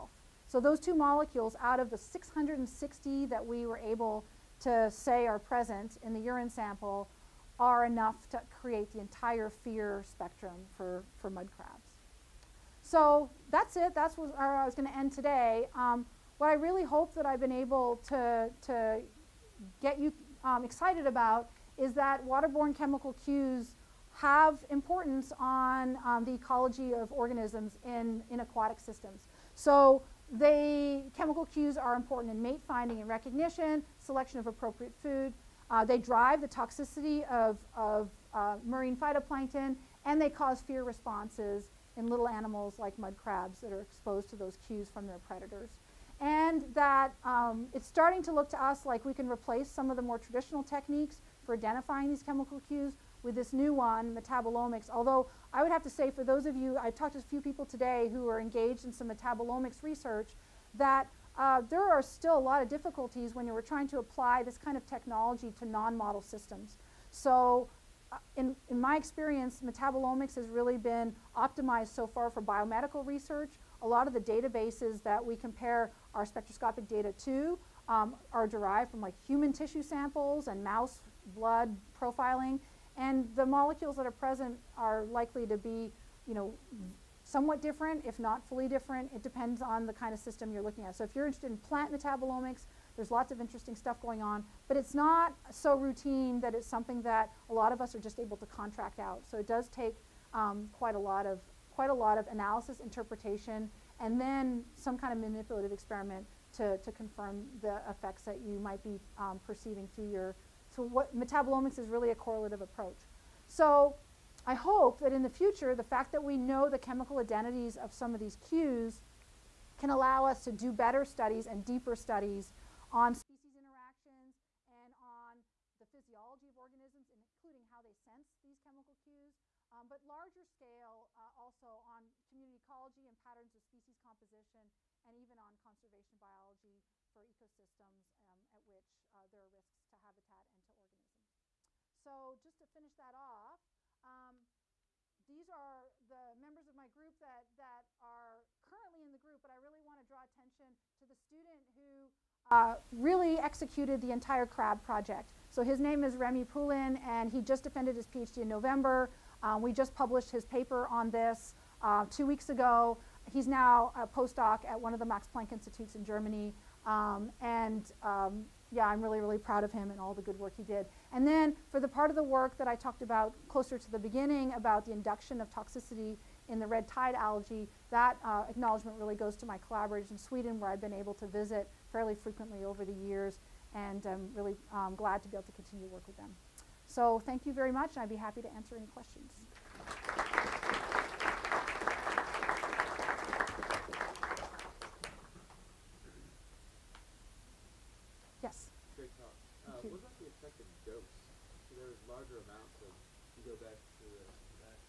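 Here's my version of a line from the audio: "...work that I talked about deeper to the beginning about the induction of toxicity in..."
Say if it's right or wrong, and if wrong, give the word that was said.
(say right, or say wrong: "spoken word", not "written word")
wrong: "closer", not "deeper".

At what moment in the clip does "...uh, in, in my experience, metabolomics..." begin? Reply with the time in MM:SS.
01:08.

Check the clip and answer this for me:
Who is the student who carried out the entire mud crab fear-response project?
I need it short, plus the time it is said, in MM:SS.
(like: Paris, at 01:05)
Remy Poulin, at 02:36.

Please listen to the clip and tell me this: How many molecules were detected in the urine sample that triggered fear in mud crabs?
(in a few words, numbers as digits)
660.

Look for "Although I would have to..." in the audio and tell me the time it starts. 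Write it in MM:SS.
00:54.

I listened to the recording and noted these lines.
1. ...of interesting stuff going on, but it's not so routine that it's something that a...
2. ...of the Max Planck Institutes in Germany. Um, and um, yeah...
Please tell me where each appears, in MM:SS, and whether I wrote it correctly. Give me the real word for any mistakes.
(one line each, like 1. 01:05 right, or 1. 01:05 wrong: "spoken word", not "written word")
1. 01:33 right
2. 02:44 right.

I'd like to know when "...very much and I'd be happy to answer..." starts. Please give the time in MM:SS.
03:07.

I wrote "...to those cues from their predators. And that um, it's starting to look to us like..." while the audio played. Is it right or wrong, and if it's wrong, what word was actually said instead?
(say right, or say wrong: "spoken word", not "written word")
right.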